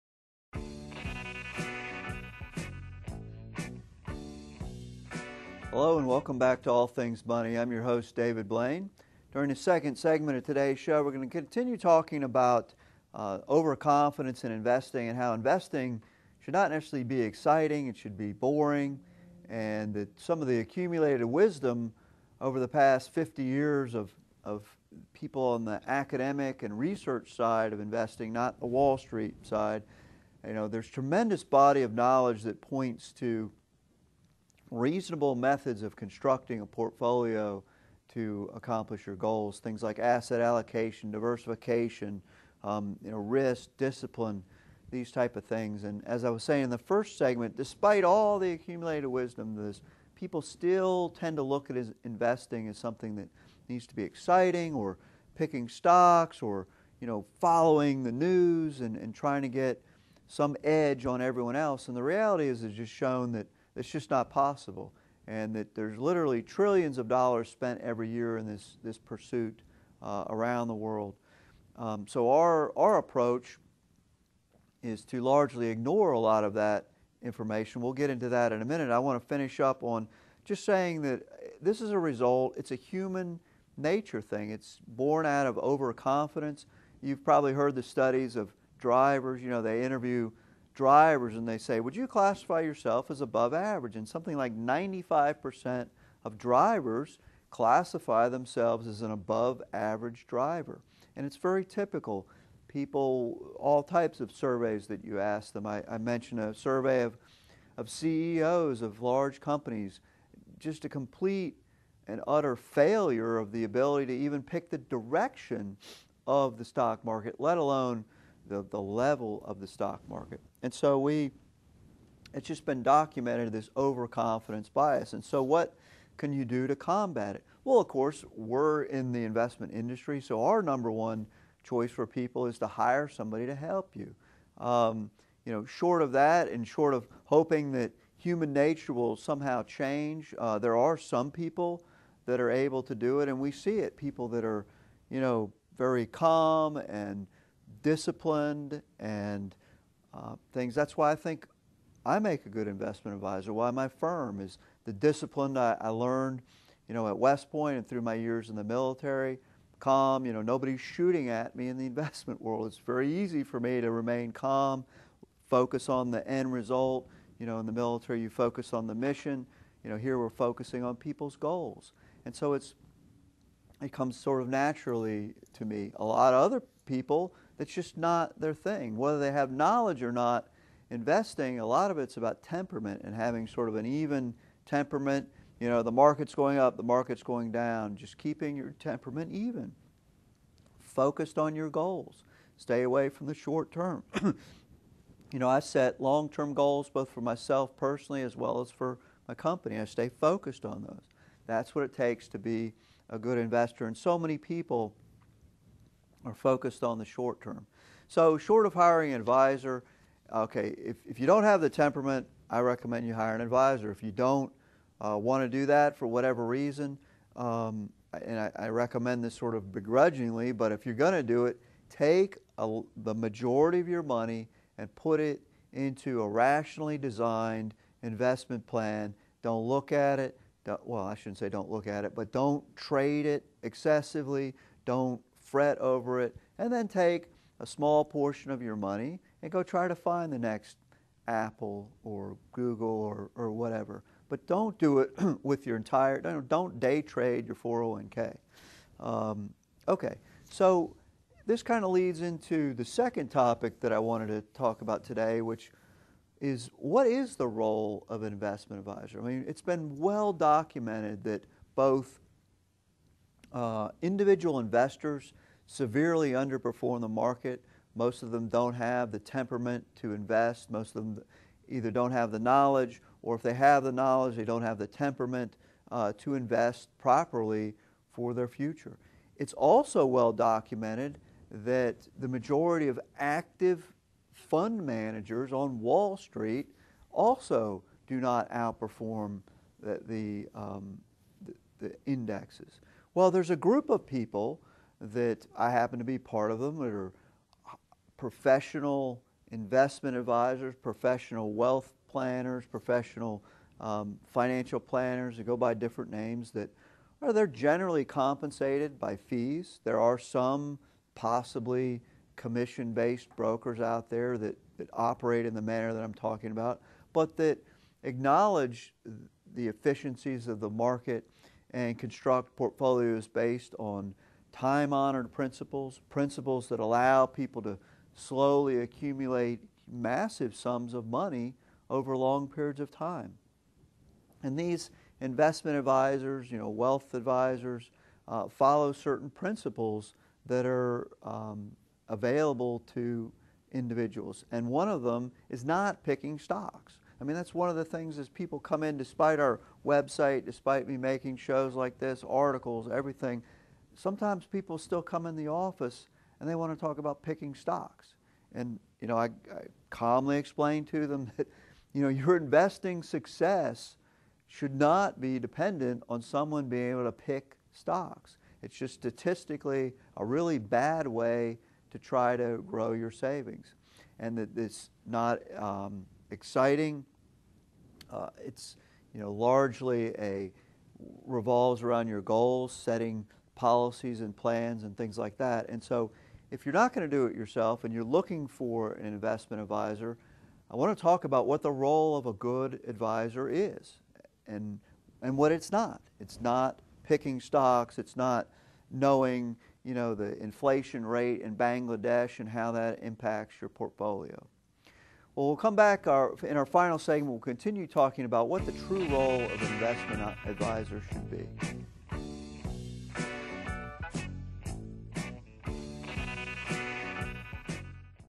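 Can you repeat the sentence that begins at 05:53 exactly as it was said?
Sometimes people still come in the office and they want to talk about picking stocks.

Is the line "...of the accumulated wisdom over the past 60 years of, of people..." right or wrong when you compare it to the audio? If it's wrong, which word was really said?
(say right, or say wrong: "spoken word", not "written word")
wrong: "50", not "60".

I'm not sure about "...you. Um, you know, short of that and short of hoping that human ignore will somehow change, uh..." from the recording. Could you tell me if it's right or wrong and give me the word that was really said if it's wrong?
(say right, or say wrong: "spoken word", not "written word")
wrong: "nature", not "ignore".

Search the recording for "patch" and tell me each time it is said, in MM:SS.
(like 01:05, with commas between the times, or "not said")
not said.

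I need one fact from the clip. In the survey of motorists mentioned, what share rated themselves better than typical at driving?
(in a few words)
95%.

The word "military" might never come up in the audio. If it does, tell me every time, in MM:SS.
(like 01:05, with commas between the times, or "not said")
02:38, 02:47.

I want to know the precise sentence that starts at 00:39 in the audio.
Things like asset allocation, diversification, um, you know, risk, discipline, these type of things.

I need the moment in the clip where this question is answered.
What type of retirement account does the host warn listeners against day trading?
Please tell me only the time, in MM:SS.
04:07.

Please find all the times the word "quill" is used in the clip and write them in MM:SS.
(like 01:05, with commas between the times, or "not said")
not said.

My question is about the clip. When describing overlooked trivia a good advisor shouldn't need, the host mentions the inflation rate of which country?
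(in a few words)
Bangladesh.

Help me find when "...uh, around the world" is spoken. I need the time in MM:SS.
01:10.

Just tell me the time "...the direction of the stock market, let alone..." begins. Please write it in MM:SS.
01:54.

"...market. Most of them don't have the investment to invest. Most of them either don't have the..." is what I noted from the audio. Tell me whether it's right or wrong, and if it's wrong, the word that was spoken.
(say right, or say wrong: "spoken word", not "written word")
wrong: "temperament", not "investment".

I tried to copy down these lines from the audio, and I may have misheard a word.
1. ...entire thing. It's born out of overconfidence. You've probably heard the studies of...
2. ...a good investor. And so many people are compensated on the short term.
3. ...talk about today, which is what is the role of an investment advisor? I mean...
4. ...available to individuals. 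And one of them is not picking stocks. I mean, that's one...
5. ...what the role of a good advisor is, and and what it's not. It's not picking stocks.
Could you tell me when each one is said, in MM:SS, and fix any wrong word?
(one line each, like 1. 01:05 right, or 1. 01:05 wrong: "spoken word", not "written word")
1. 01:23 wrong: "nature", not "entire"
2. 03:23 wrong: "focused", not "compensated"
3. 04:14 right
4. 05:42 right
5. 06:31 right.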